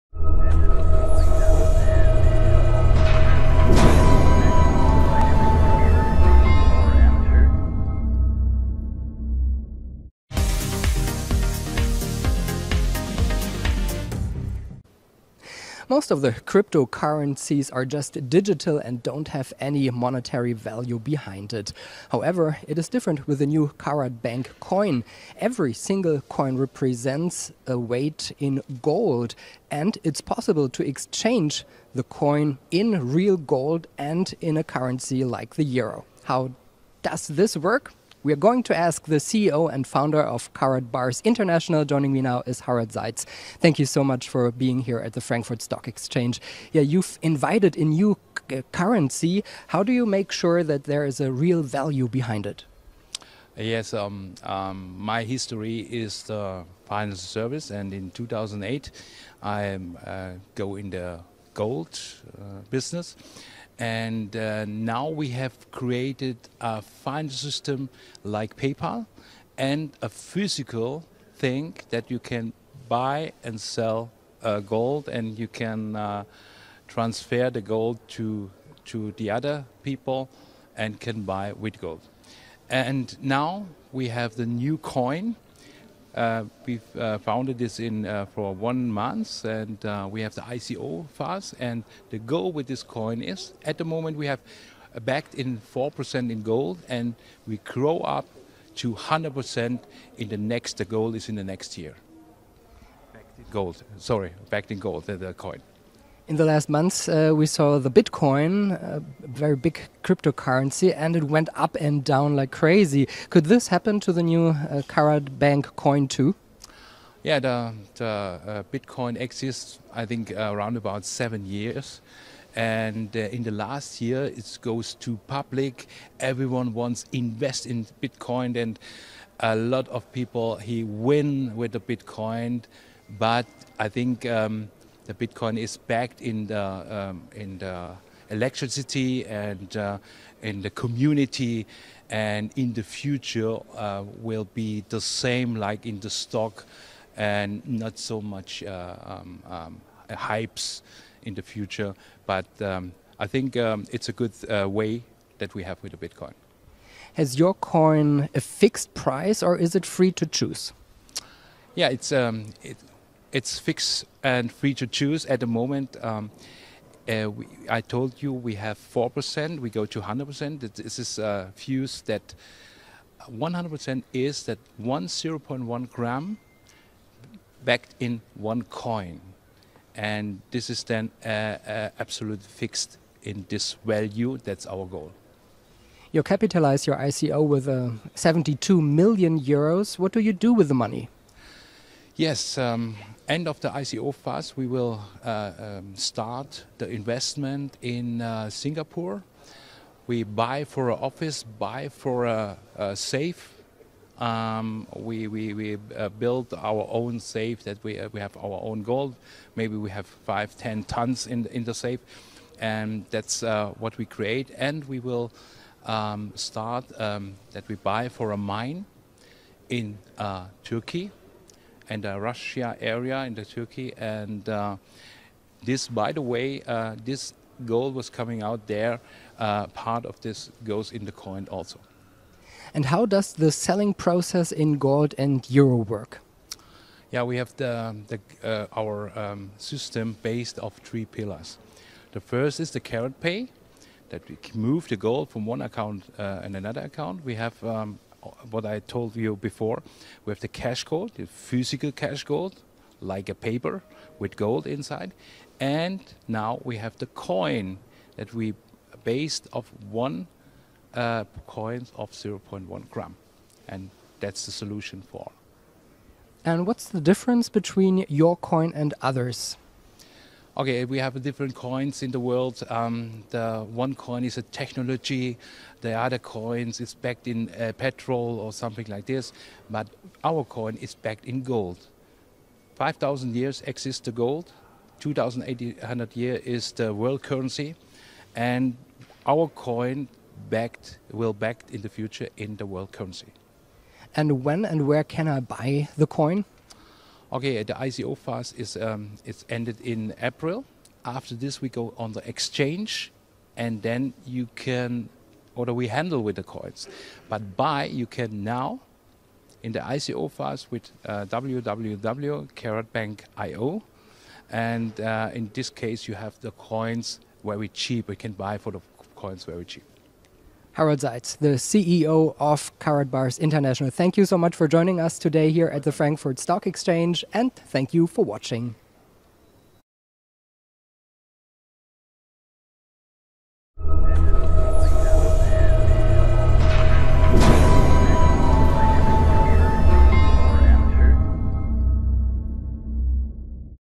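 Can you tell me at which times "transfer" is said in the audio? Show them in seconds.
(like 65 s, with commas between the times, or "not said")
76 s.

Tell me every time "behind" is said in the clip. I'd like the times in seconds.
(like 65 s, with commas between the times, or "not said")
20 s, 52 s.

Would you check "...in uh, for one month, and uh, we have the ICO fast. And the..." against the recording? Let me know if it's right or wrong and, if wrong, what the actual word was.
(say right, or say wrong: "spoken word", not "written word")
right.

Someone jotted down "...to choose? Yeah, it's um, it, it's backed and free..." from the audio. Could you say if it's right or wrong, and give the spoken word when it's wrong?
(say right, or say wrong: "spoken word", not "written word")
wrong: "fixed", not "backed".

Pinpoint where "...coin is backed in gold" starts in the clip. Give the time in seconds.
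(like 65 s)
280 s.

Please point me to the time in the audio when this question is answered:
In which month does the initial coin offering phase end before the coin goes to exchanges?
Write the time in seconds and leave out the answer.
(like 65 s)
300 s.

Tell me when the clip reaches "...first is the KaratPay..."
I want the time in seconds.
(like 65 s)
242 s.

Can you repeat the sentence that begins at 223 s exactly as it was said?
And uh, this, by the way, uh, this gold was coming out there.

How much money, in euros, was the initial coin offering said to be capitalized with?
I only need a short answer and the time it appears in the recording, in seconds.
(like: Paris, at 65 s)
72 million euros, at 188 s.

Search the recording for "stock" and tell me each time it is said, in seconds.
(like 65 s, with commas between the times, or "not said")
45 s, 146 s, 326 s.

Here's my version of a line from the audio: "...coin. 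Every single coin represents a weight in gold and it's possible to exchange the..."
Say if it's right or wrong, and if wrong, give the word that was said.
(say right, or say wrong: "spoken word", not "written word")
right.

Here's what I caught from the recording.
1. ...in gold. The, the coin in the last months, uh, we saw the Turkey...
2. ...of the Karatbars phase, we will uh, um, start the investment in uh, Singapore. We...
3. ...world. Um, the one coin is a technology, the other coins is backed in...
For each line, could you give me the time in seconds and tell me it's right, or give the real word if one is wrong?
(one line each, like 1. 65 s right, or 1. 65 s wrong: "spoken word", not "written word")
1. 104 s wrong: "Bitcoin", not "Turkey"
2. 193 s wrong: "ICO", not "Karatbars"
3. 272 s right.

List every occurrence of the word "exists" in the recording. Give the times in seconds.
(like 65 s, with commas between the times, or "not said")
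119 s, 283 s.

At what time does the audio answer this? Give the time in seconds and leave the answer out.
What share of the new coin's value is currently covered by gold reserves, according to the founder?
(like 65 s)
95 s.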